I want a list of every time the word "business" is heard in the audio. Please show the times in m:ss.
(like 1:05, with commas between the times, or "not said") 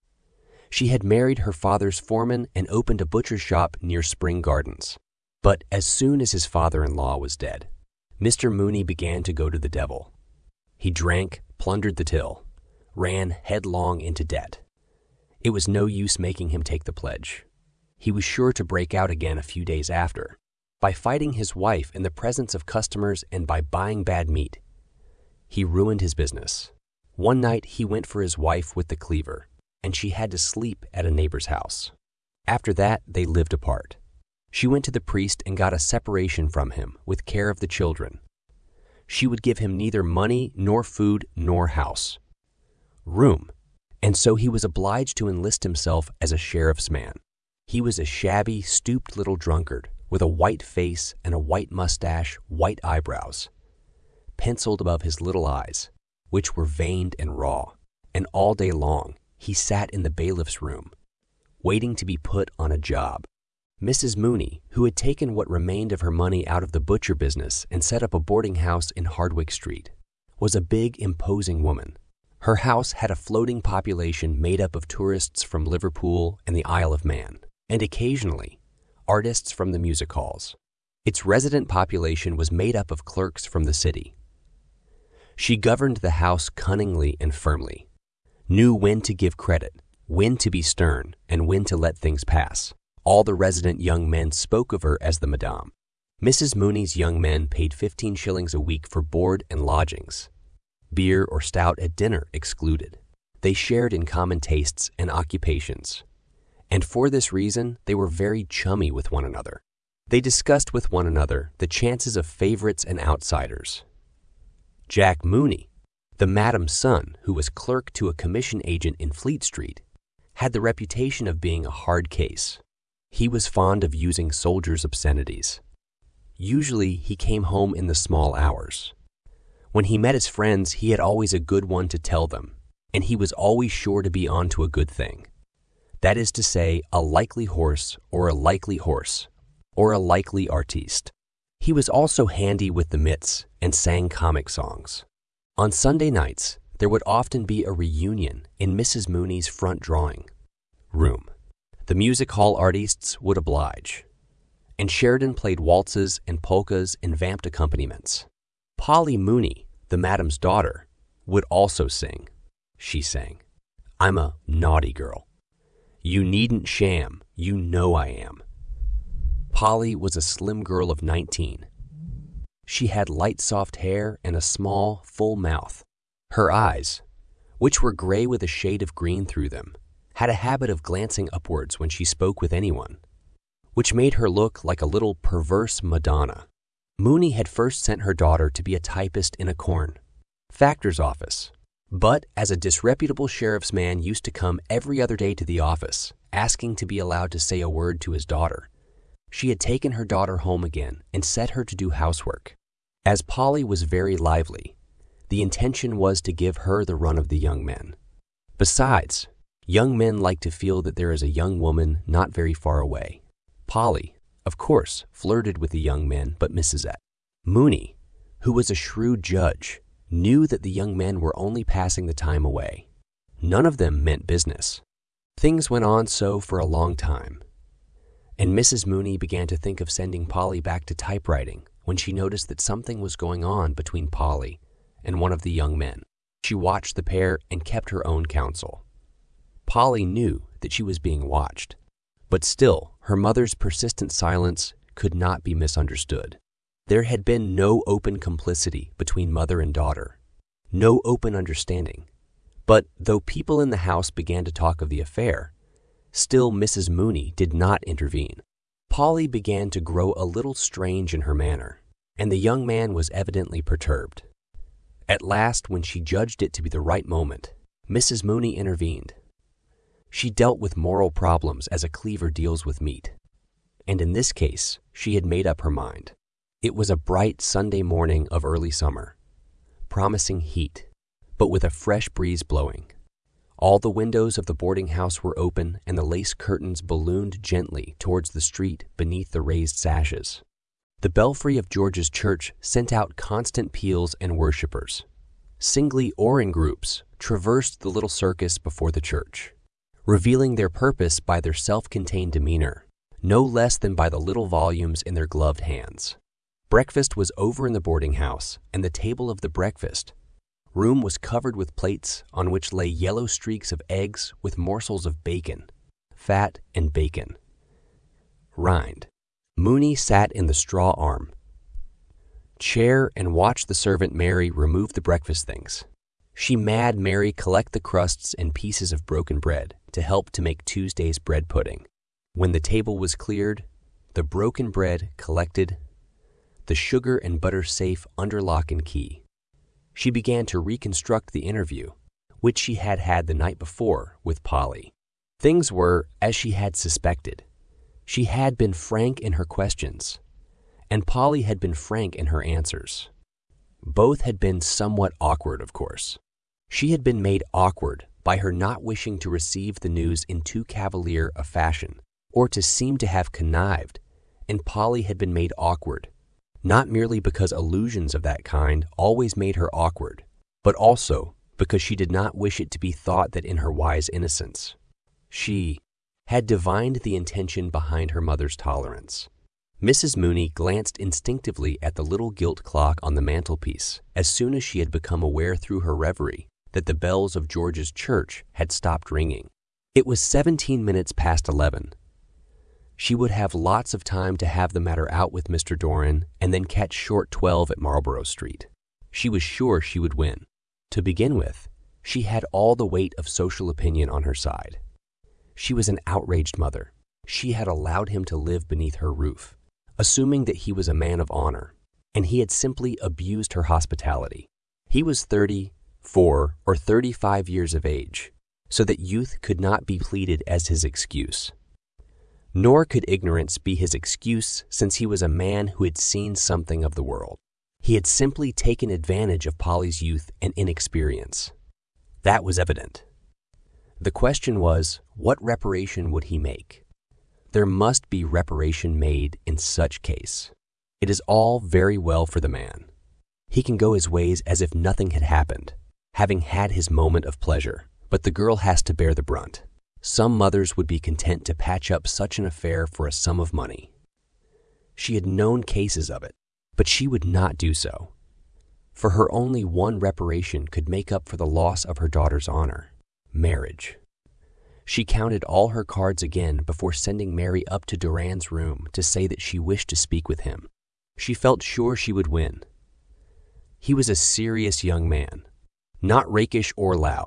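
0:26, 1:07, 3:44.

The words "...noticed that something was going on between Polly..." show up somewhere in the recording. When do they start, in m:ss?
3:52.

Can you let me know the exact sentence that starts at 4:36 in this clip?
It was a bright Sunday morning of early summer, promising heat, but with a fresh breeze blowing.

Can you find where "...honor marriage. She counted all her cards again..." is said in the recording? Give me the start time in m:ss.
7:42.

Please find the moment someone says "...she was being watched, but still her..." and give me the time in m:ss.
4:00.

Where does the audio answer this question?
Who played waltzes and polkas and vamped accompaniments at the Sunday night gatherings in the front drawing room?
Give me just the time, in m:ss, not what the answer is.
2:34.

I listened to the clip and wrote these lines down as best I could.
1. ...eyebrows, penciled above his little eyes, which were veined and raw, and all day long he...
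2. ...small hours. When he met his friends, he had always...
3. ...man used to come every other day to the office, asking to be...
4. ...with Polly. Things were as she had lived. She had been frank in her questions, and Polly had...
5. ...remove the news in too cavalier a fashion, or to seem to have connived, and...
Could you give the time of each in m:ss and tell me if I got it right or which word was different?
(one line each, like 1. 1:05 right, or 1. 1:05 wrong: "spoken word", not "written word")
1. 0:52 right
2. 2:07 right
3. 3:13 right
4. 5:44 wrong: "suspected", not "lived"
5. 5:59 wrong: "receive", not "remove".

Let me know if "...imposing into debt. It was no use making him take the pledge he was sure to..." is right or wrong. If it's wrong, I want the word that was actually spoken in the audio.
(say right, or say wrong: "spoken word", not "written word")
wrong: "headlong", not "imposing".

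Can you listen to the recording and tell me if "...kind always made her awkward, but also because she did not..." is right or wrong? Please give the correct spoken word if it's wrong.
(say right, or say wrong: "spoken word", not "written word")
right.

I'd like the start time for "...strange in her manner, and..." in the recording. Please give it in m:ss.
4:20.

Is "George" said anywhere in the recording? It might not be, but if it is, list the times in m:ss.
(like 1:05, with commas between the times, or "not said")
4:51, 6:27.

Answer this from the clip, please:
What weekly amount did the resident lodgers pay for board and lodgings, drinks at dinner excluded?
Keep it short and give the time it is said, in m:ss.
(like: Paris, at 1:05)
15 shillings, at 1:37.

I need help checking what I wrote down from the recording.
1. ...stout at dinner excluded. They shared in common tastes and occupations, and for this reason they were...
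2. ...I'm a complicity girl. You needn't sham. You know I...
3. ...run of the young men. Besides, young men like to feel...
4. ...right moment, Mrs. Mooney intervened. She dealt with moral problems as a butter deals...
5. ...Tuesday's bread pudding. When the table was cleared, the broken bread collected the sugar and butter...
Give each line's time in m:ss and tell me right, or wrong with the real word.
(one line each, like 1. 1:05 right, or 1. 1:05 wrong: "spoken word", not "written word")
1. 1:41 right
2. 2:43 wrong: "naughty", not "complicity"
3. 3:26 right
4. 4:26 wrong: "cleaver", not "butter"
5. 5:30 right.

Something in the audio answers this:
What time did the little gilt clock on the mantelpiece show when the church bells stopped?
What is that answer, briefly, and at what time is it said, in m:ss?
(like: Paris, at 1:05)
11:17, at 6:30.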